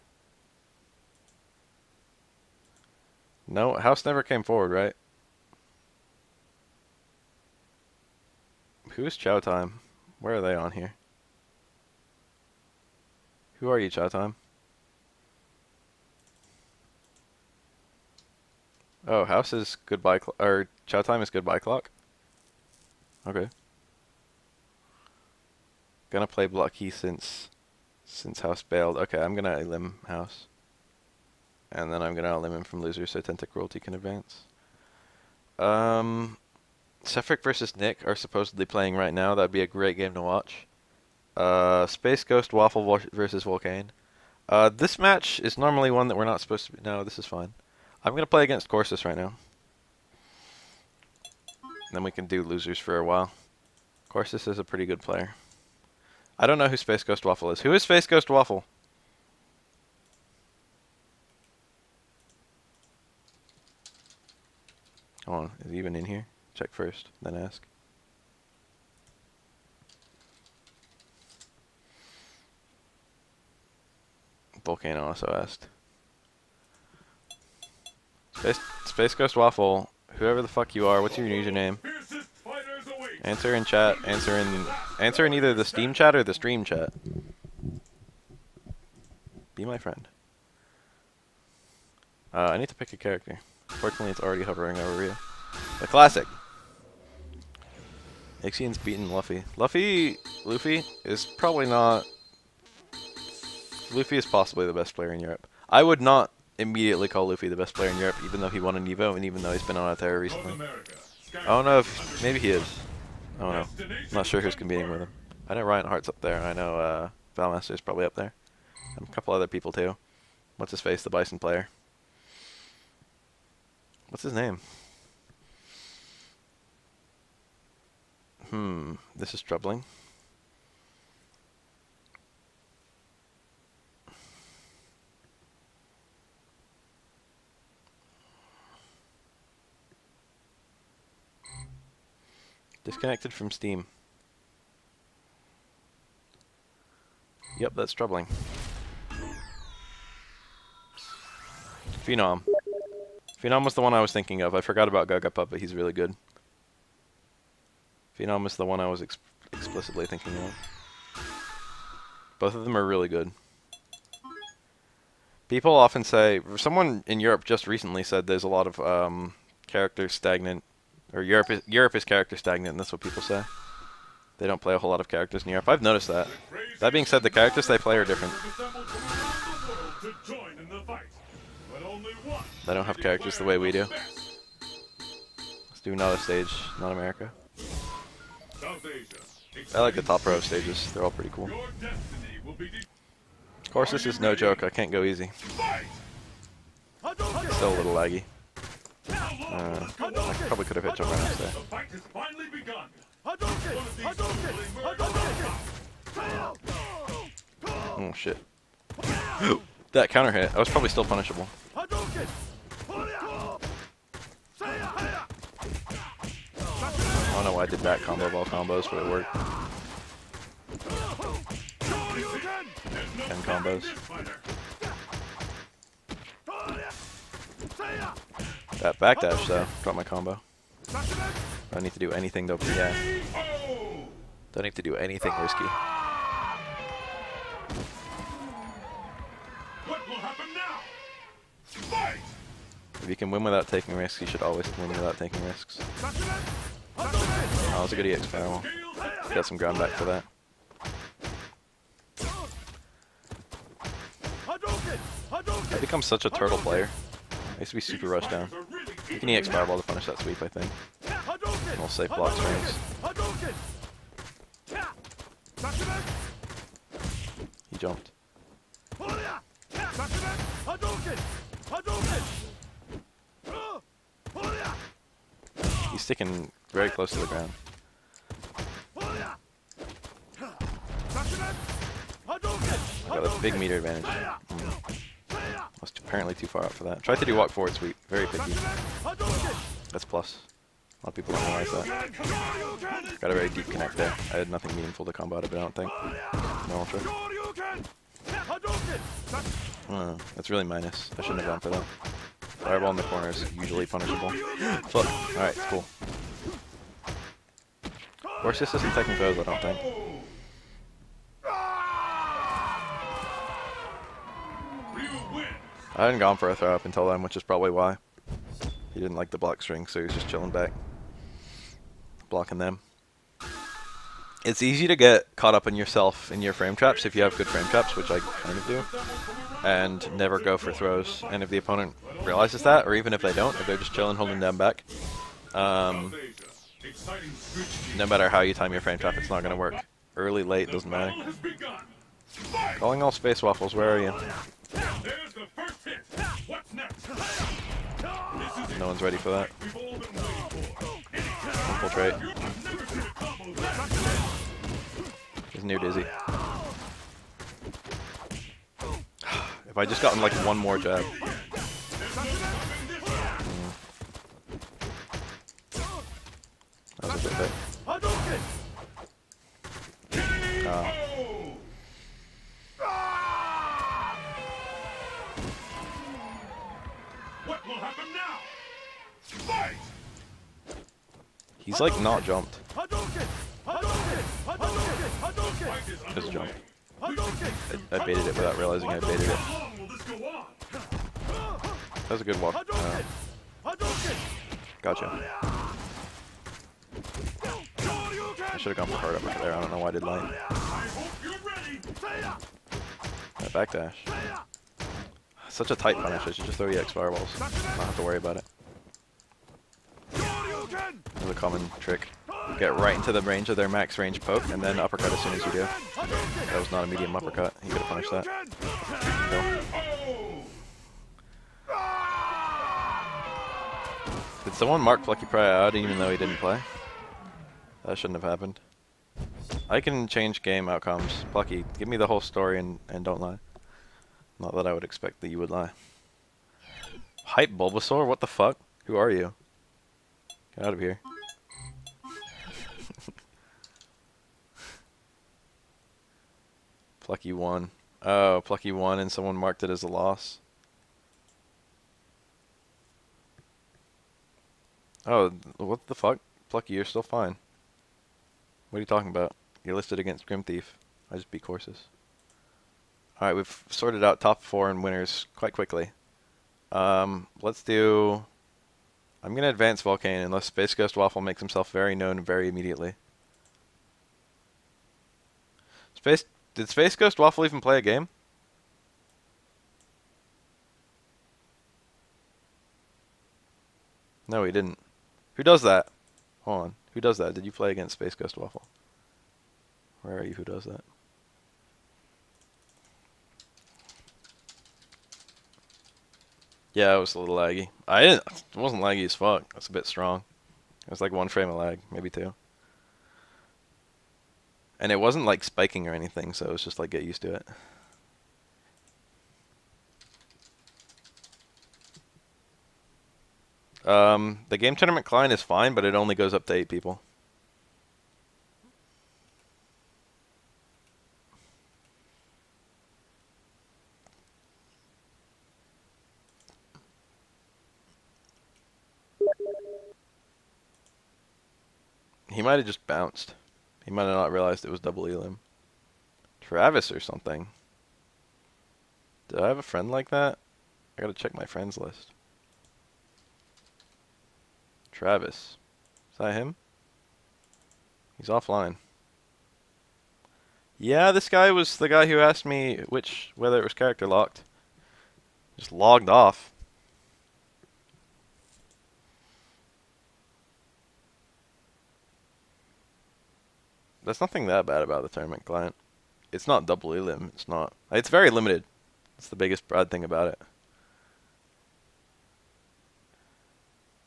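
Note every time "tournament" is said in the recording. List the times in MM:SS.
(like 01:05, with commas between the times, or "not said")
08:34, 09:25.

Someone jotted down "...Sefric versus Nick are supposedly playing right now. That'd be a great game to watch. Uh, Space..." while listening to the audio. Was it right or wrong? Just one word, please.
right.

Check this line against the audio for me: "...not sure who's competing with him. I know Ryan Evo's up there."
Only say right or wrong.
wrong.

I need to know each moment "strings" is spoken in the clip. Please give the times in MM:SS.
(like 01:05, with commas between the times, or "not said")
04:22, 05:19.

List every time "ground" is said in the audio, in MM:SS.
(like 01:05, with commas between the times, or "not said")
04:09, 04:37.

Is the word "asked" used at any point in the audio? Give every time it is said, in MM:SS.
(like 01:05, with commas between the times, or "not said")
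01:15, 09:12.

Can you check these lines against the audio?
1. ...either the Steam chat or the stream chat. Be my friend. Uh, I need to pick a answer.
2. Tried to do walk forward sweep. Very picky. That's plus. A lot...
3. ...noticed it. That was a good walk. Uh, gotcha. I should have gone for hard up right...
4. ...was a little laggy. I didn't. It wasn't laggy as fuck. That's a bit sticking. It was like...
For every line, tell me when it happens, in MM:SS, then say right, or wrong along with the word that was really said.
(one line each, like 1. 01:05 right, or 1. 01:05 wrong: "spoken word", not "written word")
1. 01:25 wrong: "character", not "answer"
2. 04:47 right
3. 06:28 wrong: "baited", not "noticed"
4. 08:16 wrong: "strong", not "sticking".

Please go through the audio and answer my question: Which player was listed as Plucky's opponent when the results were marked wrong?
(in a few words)
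Grim Thief.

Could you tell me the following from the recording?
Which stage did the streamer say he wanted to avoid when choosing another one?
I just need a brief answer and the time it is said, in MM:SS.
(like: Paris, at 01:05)
America, at 03:06.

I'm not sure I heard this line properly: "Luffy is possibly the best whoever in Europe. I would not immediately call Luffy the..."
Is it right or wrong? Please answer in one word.
wrong.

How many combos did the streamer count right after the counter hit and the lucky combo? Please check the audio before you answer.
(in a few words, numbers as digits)
10.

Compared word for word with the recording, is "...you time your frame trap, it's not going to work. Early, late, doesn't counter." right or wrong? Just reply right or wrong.
wrong.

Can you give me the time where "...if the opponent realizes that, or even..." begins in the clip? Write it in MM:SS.
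05:31.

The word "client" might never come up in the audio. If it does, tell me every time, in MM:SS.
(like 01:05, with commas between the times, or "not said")
08:35, 09:25.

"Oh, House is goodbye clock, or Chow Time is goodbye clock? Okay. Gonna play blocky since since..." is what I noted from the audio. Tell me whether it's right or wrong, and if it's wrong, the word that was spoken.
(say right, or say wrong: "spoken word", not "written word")
right.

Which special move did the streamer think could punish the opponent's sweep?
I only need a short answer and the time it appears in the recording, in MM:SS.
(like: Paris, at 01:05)
EX Fireball, at 04:19.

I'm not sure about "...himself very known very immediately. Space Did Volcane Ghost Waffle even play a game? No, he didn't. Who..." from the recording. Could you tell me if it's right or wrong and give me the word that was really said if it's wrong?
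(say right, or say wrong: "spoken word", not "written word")
wrong: "Space", not "Volcane".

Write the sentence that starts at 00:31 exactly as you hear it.
And then I'm gonna elim him from loser so Tentacruelty can advance.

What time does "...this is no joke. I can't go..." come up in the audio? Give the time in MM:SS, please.
03:13.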